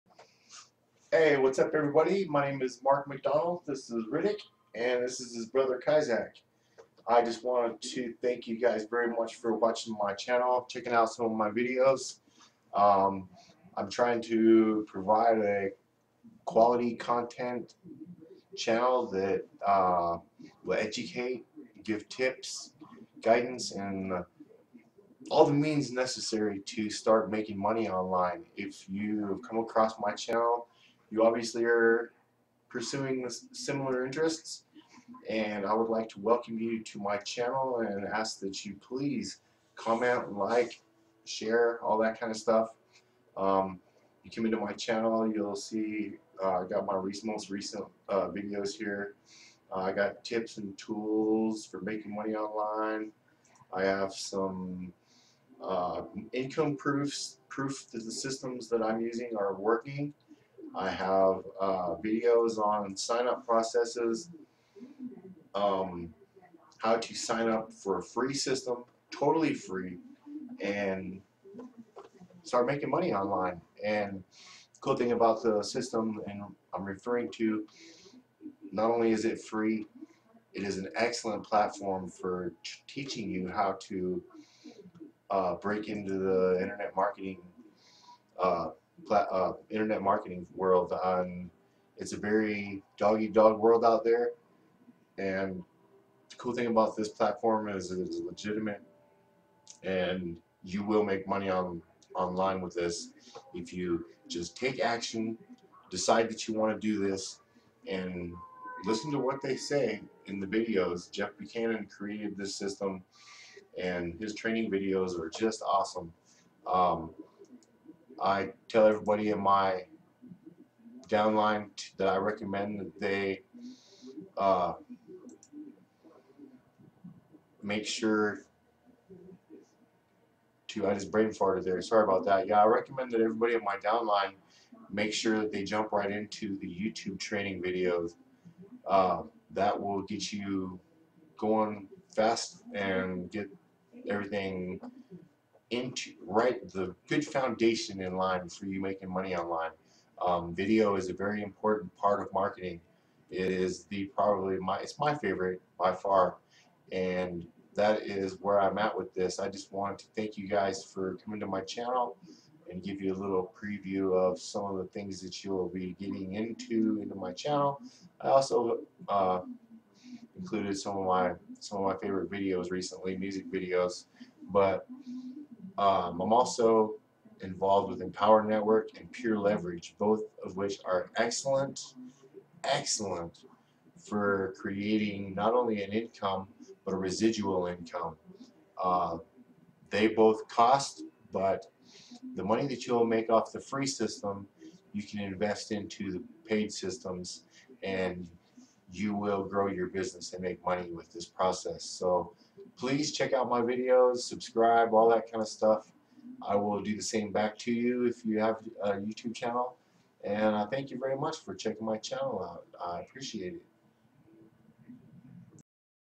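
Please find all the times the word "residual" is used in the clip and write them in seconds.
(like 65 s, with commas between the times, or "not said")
186 s.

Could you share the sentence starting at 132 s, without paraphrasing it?
Yeah, I recommend that everybody in my downline make sure that they jump right into the YouTube training videos.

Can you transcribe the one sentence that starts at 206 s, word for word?
I will do the same back to you if you have a YouTube channel.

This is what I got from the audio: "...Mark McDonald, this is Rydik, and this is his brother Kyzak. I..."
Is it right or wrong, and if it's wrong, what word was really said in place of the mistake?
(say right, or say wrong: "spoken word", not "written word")
right.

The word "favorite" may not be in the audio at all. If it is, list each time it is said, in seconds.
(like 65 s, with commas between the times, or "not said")
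155 s, 172 s.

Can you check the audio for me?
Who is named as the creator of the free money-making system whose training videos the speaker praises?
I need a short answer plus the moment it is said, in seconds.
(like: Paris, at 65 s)
Jeff Buchanan, at 111 s.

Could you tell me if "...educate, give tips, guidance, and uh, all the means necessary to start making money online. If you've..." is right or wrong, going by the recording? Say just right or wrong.
right.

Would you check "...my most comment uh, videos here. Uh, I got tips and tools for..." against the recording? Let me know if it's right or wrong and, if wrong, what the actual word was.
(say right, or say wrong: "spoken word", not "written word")
wrong: "recent", not "comment".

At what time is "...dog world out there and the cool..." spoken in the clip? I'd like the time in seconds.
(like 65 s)
93 s.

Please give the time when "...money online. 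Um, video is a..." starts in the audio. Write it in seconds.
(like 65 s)
149 s.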